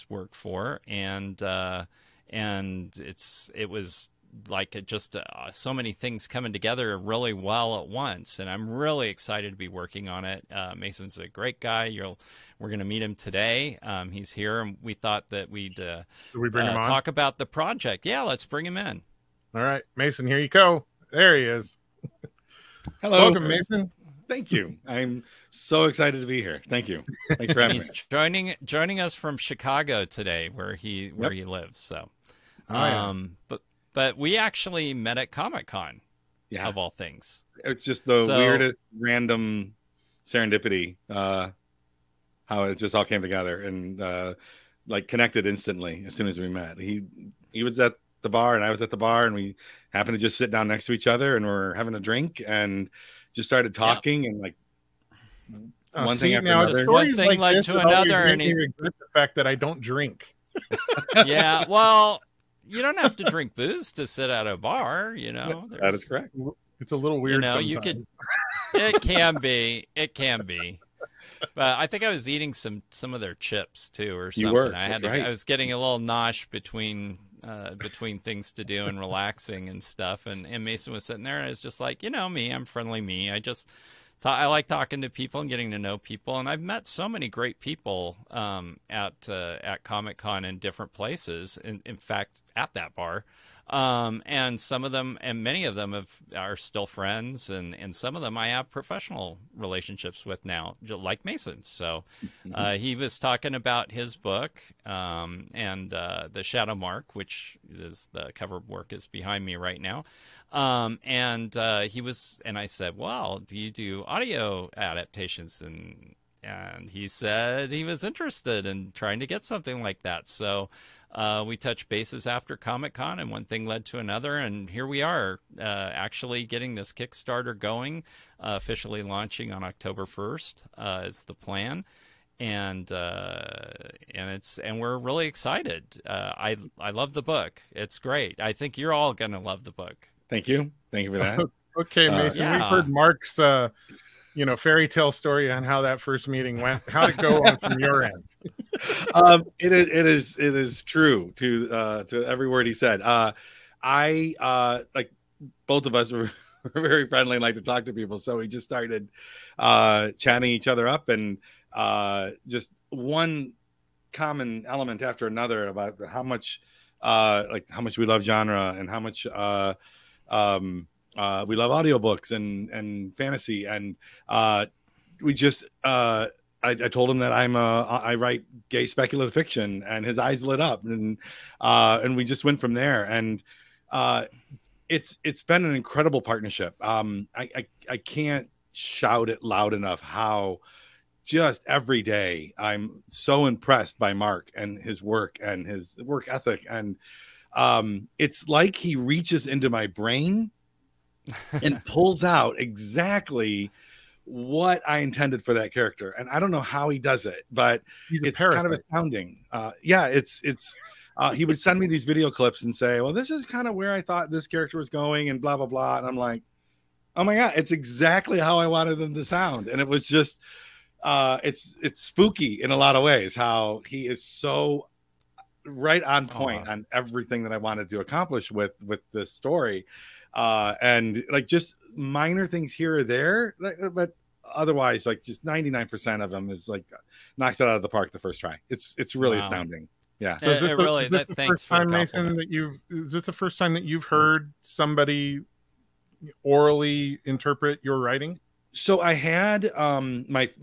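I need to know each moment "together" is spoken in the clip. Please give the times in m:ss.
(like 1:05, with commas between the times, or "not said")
0:06, 0:43.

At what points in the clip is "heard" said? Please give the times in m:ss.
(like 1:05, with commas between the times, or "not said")
2:22, 4:04.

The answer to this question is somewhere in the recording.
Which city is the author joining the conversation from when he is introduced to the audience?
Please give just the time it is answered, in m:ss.
0:29.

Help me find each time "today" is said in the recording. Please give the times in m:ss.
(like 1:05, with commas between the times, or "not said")
0:13, 0:30.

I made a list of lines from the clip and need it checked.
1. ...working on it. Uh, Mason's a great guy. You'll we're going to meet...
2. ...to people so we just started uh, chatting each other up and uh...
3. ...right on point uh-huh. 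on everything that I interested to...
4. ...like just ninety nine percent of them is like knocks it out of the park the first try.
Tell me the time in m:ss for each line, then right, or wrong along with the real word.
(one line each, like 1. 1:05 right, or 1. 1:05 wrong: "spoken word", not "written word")
1. 0:09 right
2. 2:37 right
3. 3:45 wrong: "wanted", not "interested"
4. 3:55 right.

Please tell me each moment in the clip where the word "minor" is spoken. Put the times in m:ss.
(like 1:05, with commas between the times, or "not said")
3:51.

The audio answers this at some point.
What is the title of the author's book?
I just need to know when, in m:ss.
1:46.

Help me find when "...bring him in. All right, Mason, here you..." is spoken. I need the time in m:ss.
0:18.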